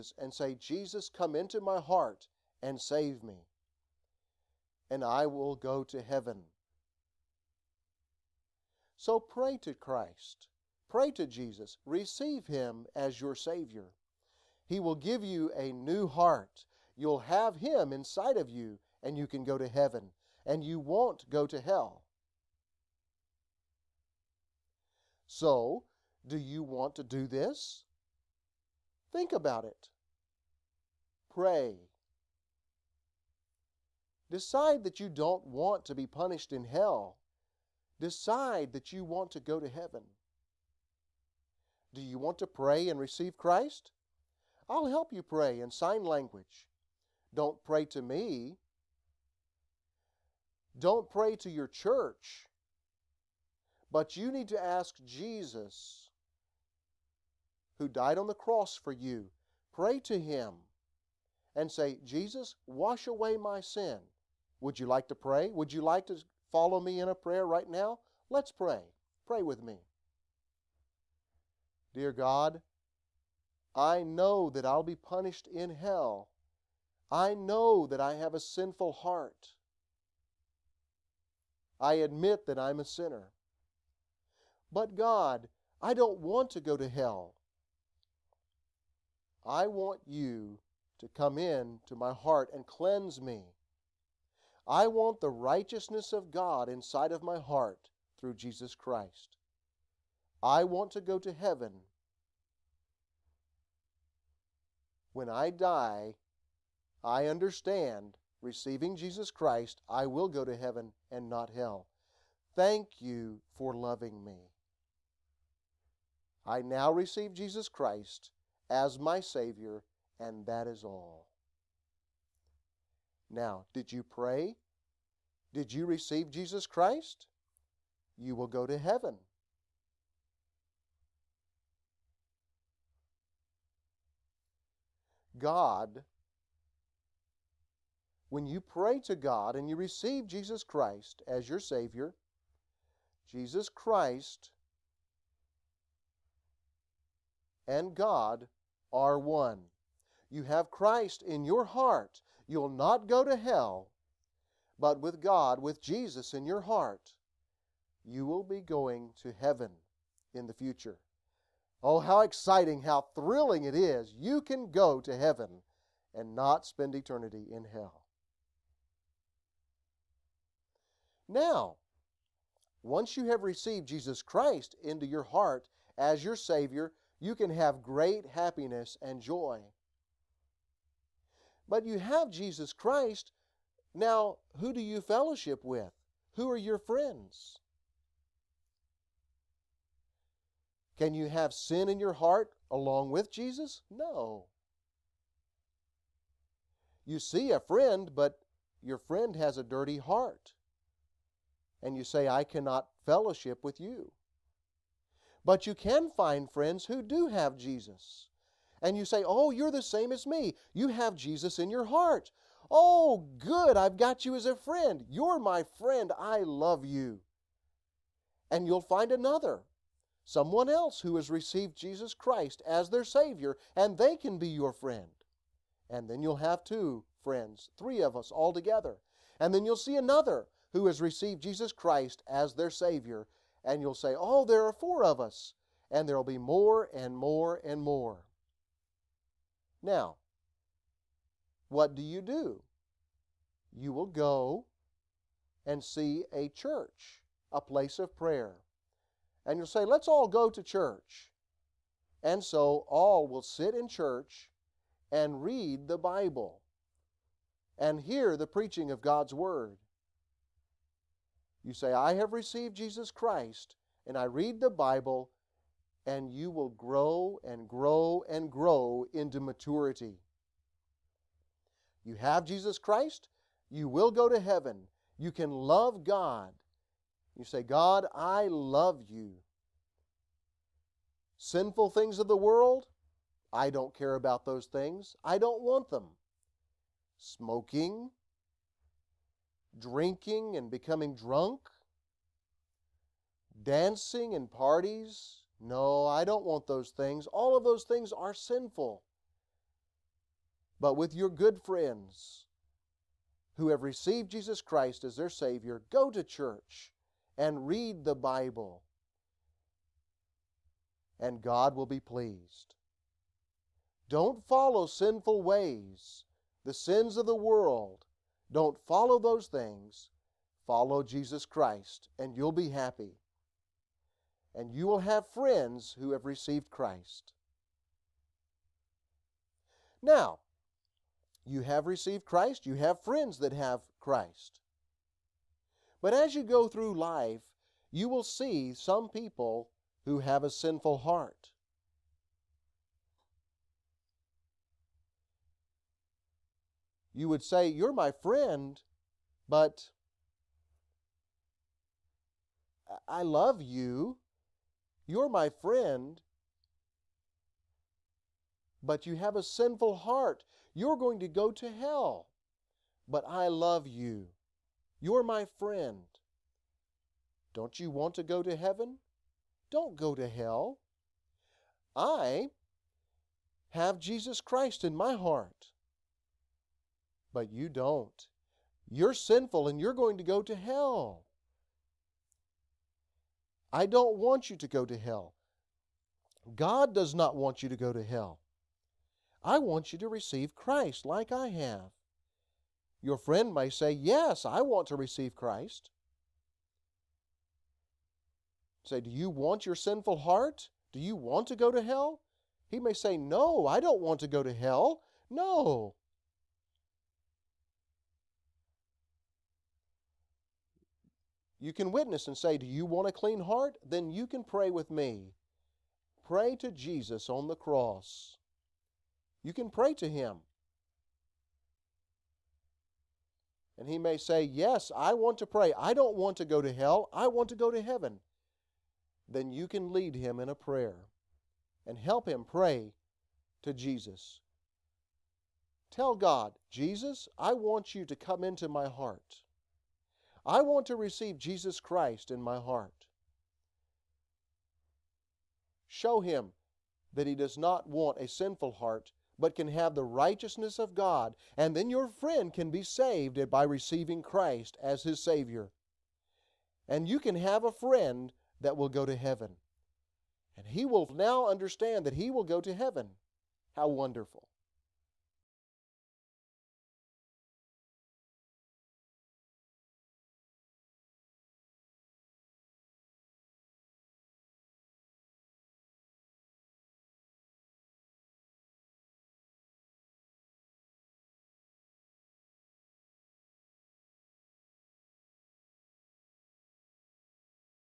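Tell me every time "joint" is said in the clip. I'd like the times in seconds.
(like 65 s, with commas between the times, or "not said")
not said.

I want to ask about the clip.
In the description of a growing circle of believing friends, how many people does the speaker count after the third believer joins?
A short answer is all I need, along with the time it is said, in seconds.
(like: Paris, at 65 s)
4, at 234 s.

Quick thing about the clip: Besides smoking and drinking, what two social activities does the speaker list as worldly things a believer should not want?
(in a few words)
dancing and parties.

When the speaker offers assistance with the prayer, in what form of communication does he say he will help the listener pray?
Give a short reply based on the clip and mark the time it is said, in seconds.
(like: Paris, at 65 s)
sign language, at 45 s.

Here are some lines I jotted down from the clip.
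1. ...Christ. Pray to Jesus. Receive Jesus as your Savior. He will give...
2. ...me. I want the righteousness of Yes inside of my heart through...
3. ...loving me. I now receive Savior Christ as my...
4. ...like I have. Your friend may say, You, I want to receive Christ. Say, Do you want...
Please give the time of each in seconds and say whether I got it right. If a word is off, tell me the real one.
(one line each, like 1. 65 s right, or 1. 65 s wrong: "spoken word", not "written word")
1. 9 s wrong: "Him", not "Jesus"
2. 93 s wrong: "God", not "Yes"
3. 113 s wrong: "Jesus", not "Savior"
4. 391 s wrong: "Yes", not "You".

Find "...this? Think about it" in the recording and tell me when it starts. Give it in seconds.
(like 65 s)
27 s.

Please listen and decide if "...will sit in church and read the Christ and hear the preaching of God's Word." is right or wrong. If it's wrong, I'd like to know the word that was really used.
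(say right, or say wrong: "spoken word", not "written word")
wrong: "Bible", not "Christ".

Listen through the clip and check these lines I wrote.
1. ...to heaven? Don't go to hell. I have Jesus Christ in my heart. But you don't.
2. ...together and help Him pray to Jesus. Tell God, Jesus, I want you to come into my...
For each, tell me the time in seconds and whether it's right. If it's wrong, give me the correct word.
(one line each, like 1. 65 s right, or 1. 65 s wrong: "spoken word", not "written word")
1. 368 s right
2. 430 s wrong: "prayer", not "together".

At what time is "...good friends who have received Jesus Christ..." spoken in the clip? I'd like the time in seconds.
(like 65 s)
301 s.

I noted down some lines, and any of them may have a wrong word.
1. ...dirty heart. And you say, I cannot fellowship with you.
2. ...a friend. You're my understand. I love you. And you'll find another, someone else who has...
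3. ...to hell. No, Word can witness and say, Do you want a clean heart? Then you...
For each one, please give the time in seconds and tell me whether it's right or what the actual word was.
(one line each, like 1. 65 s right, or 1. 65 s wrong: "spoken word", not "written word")
1. 199 s right
2. 214 s wrong: "friend", not "understand"
3. 404 s wrong: "You", not "Word".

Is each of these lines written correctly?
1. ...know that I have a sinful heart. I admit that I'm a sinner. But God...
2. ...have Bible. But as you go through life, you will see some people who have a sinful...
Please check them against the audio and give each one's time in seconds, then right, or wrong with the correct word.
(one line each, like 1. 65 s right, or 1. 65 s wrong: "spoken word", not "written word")
1. 77 s right
2. 333 s wrong: "Christ", not "Bible".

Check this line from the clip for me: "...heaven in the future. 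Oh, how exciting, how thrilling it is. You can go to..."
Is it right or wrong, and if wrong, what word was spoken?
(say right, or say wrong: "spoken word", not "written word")
right.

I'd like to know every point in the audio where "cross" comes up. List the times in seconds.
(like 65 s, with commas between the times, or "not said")
58 s, 417 s.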